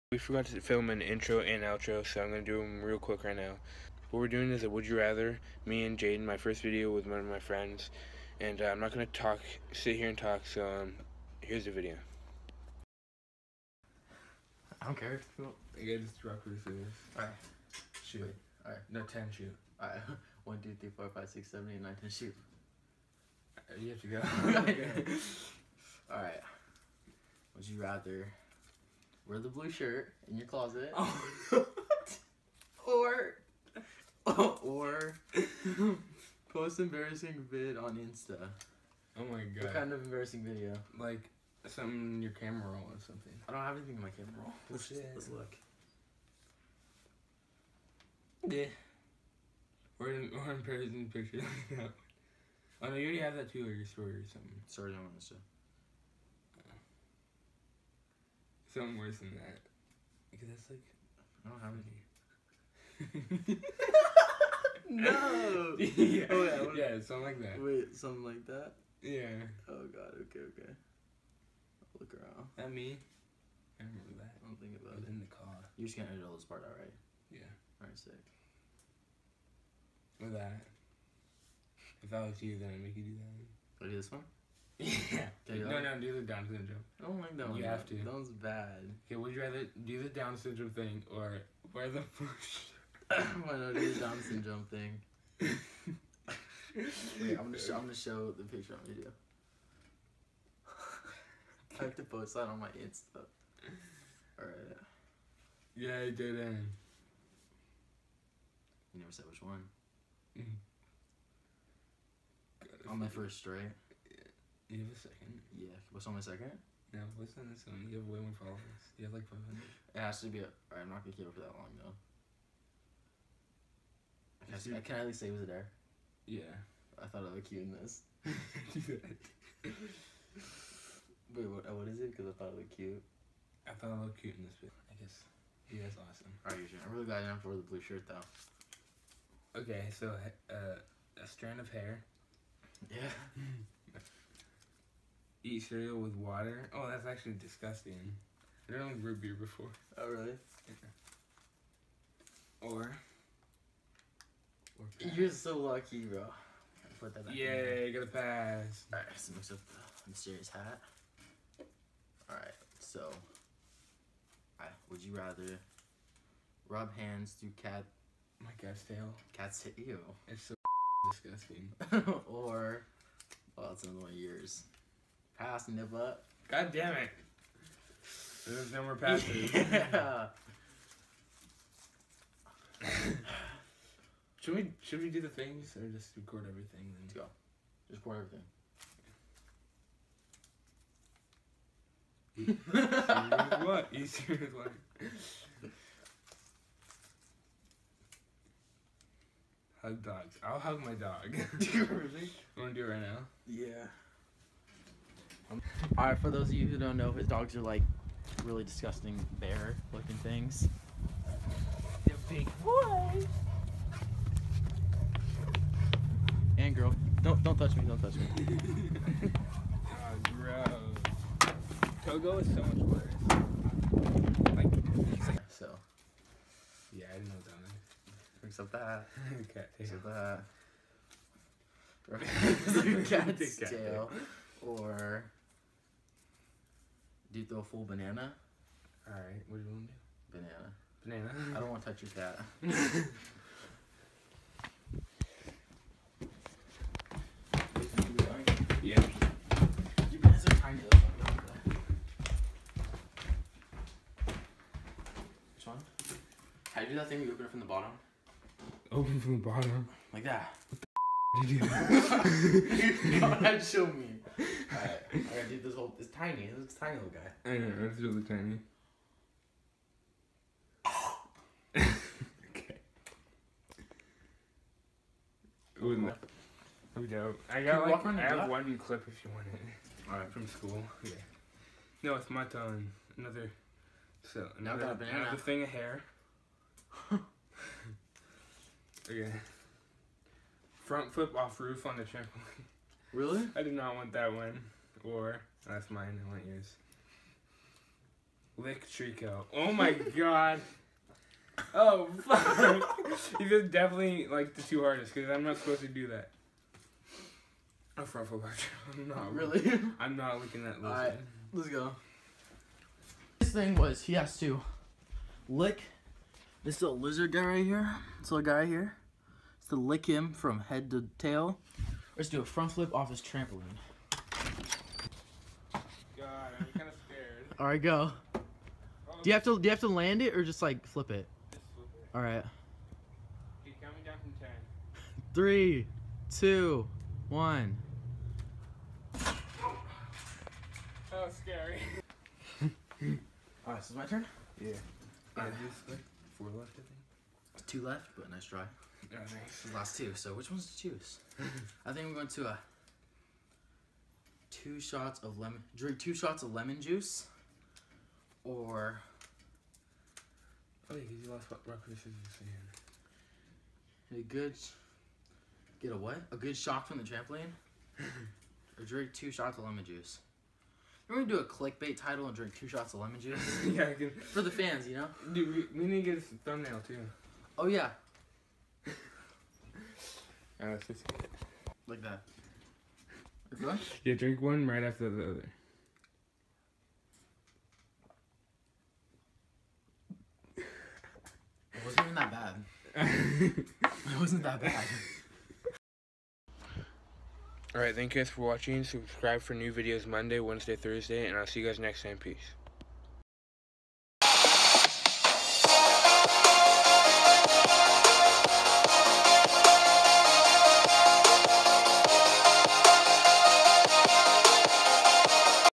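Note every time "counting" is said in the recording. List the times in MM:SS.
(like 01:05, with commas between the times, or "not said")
05:33.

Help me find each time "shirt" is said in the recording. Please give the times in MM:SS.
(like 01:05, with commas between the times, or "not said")
00:29, 02:17.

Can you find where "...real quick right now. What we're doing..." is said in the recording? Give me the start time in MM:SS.
00:02.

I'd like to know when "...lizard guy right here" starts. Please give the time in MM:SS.
05:16.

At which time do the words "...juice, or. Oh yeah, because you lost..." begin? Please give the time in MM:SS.
05:56.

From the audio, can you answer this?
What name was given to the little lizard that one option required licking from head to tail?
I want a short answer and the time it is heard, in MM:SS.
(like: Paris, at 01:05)
Trico, at 04:58.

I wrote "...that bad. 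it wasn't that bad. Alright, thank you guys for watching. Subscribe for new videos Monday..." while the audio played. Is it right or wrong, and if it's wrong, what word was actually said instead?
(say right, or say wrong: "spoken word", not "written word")
right.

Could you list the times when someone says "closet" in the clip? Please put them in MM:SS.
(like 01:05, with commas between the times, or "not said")
00:30.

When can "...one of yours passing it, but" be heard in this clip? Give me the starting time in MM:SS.
02:54.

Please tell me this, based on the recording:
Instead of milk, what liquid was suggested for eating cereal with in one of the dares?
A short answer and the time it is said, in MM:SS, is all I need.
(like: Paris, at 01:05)
Water, at 02:25.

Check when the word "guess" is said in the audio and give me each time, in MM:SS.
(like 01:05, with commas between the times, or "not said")
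02:15.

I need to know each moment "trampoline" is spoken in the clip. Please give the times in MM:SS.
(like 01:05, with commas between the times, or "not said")
04:52, 05:23, 06:07.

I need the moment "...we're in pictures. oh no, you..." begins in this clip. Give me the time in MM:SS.
00:50.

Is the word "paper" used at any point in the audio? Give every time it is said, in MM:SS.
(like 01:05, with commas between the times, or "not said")
06:01.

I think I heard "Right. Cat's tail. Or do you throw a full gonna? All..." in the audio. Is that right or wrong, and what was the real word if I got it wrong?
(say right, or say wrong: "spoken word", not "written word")
wrong: "banana", not "gonna".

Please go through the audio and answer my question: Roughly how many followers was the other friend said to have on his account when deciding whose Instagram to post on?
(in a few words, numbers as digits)
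500.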